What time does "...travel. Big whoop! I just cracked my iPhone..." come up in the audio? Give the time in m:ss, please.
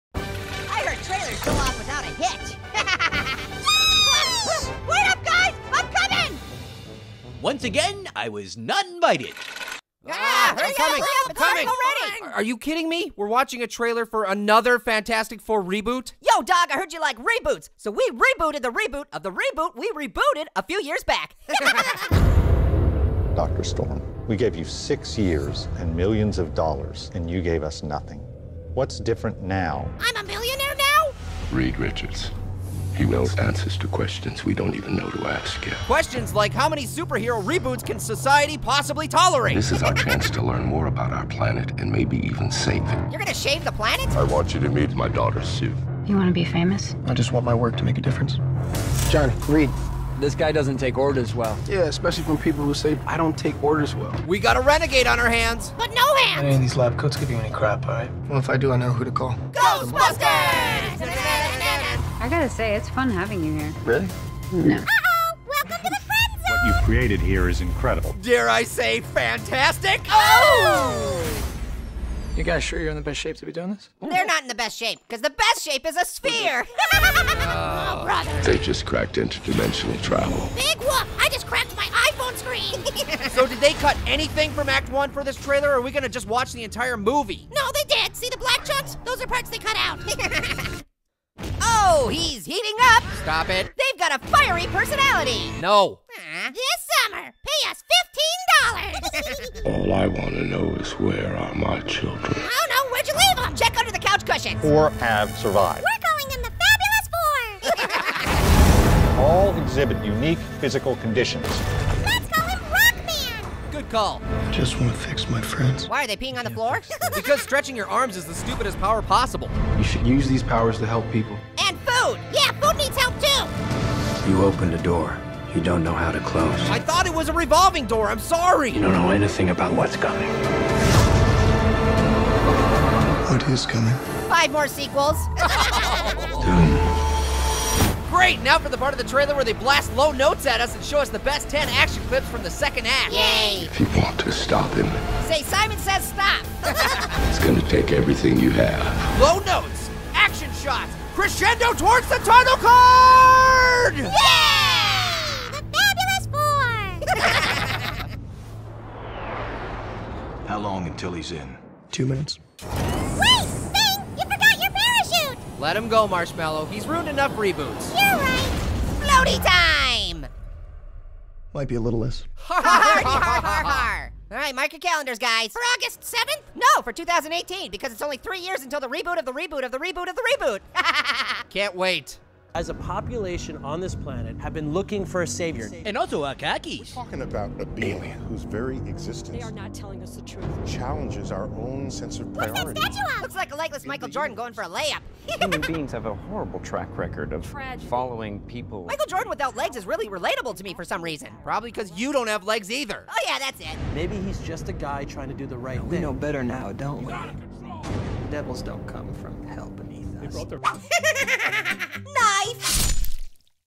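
1:20.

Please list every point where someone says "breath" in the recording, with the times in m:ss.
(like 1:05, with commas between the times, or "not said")
not said.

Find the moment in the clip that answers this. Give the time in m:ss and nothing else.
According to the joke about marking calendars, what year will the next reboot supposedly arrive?
2:56.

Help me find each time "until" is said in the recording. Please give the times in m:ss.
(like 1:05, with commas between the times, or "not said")
2:40, 2:58.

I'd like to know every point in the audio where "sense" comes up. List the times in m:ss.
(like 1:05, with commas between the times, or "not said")
3:11.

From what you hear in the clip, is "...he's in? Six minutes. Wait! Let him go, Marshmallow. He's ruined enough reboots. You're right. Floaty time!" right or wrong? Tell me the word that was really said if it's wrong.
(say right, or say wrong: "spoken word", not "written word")
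wrong: "Two", not "Six".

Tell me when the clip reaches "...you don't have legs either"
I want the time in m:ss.
3:21.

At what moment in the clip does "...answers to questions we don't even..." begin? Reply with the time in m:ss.
0:33.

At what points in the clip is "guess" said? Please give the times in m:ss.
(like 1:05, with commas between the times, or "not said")
not said.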